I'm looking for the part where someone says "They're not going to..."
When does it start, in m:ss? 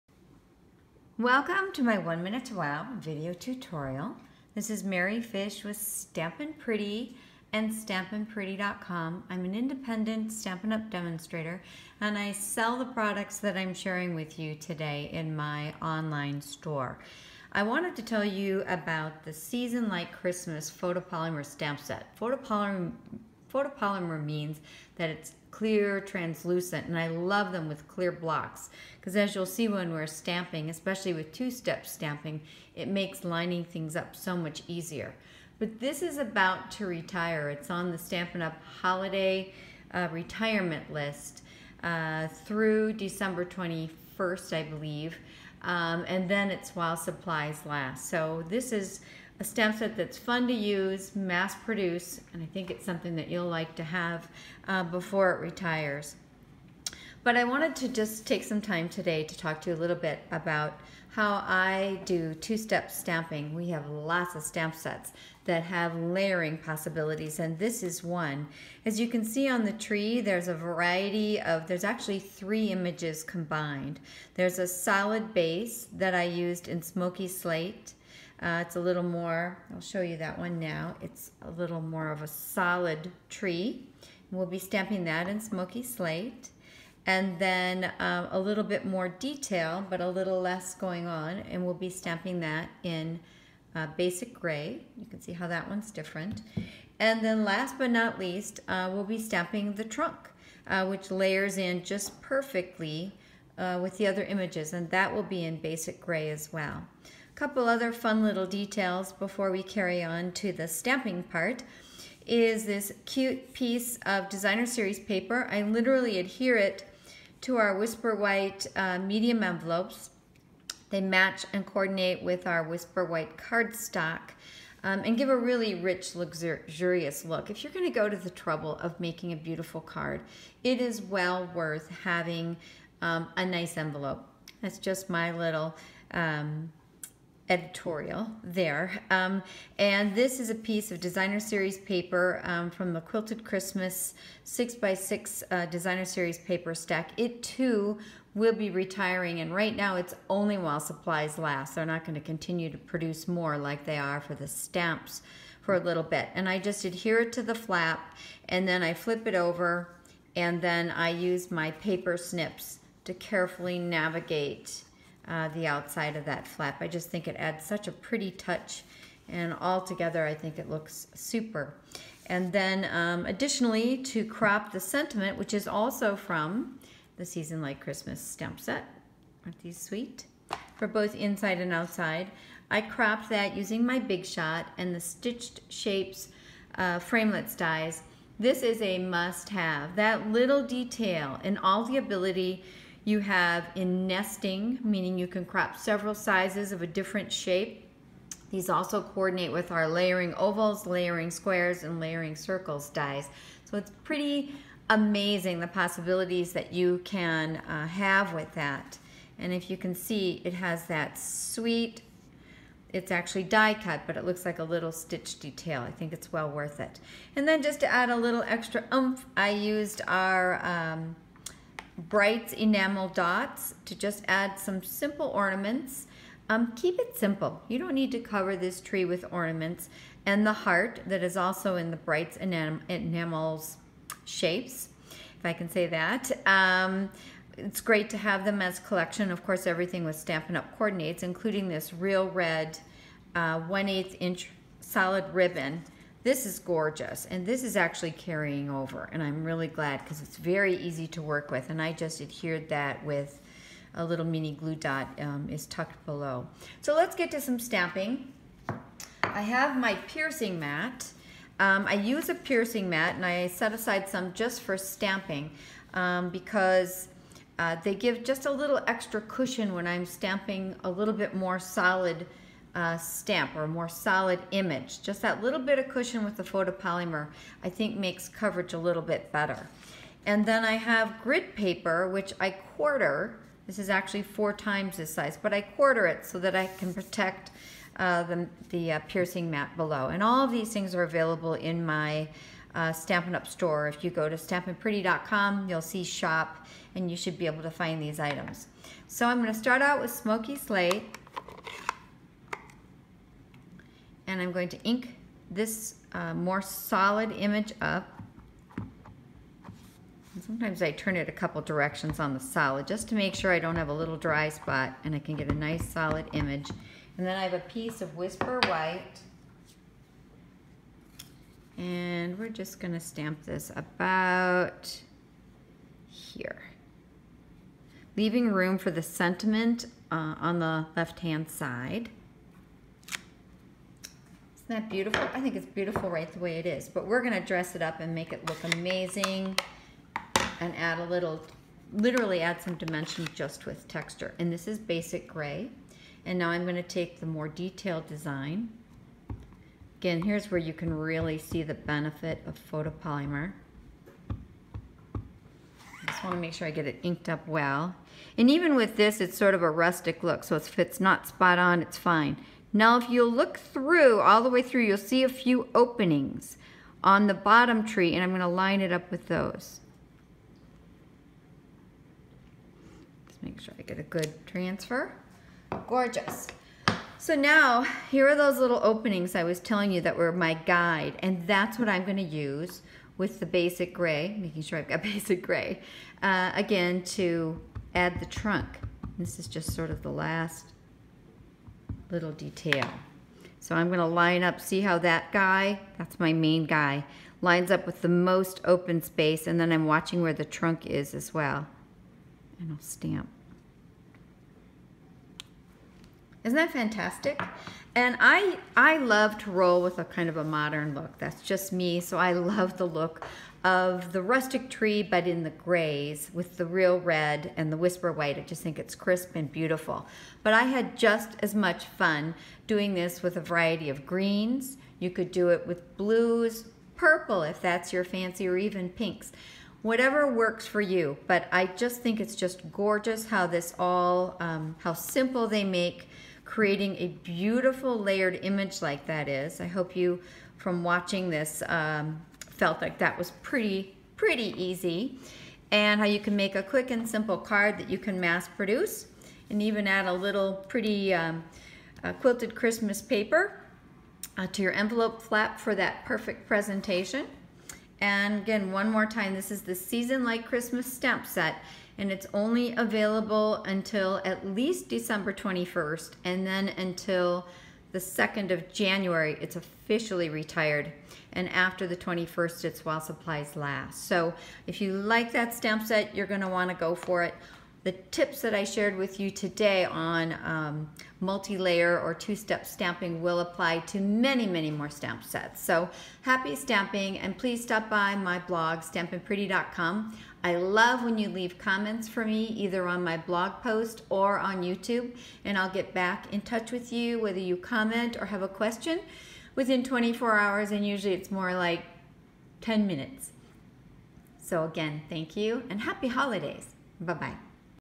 2:31.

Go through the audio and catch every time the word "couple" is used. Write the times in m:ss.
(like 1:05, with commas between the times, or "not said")
1:47, 5:11.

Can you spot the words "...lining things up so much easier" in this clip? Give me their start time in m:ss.
0:33.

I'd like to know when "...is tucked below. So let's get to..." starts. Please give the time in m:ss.
4:15.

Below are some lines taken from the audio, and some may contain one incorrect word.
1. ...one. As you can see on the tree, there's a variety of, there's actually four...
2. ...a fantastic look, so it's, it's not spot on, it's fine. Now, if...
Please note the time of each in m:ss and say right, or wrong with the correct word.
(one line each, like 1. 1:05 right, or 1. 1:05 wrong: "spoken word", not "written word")
1. 1:08 wrong: "three", not "four"
2. 5:59 wrong: "rustic", not "fantastic".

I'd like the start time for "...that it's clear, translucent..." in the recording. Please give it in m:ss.
0:24.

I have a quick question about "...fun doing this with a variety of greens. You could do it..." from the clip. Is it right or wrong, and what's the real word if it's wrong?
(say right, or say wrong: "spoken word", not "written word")
right.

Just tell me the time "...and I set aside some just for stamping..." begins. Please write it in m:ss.
4:23.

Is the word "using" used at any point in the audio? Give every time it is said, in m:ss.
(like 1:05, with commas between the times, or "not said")
3:03.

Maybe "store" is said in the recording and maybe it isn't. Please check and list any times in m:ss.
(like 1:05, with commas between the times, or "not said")
0:16, 4:53.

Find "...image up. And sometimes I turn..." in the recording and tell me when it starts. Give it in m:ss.
5:07.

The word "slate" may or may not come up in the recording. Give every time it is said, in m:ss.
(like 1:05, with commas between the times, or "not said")
1:17, 1:25, 5:00.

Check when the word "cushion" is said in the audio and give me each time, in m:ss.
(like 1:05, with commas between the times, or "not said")
4:29, 4:35.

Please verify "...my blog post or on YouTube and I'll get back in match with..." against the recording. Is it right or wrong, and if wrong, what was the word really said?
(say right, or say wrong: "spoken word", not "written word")
wrong: "touch", not "match".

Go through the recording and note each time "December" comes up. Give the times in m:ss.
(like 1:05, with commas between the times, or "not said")
0:42, 7:44.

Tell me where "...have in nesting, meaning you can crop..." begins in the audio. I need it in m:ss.
3:13.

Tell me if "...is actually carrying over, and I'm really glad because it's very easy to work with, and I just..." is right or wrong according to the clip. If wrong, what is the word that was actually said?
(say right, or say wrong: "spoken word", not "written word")
right.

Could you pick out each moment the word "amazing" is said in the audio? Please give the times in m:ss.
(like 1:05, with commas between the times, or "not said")
3:24, 5:38.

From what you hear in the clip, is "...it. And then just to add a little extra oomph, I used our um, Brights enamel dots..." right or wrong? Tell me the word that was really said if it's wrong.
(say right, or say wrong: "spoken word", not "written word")
right.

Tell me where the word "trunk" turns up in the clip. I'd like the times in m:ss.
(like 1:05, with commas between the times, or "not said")
1:39, 6:28, 6:40.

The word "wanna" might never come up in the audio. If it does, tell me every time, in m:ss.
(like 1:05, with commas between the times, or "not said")
5:56, 7:56.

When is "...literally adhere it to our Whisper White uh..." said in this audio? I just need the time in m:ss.
1:55.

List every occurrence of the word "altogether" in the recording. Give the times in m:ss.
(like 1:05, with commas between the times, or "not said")
2:49.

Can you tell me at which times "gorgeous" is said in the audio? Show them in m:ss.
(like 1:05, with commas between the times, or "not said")
4:06, 6:15, 7:12.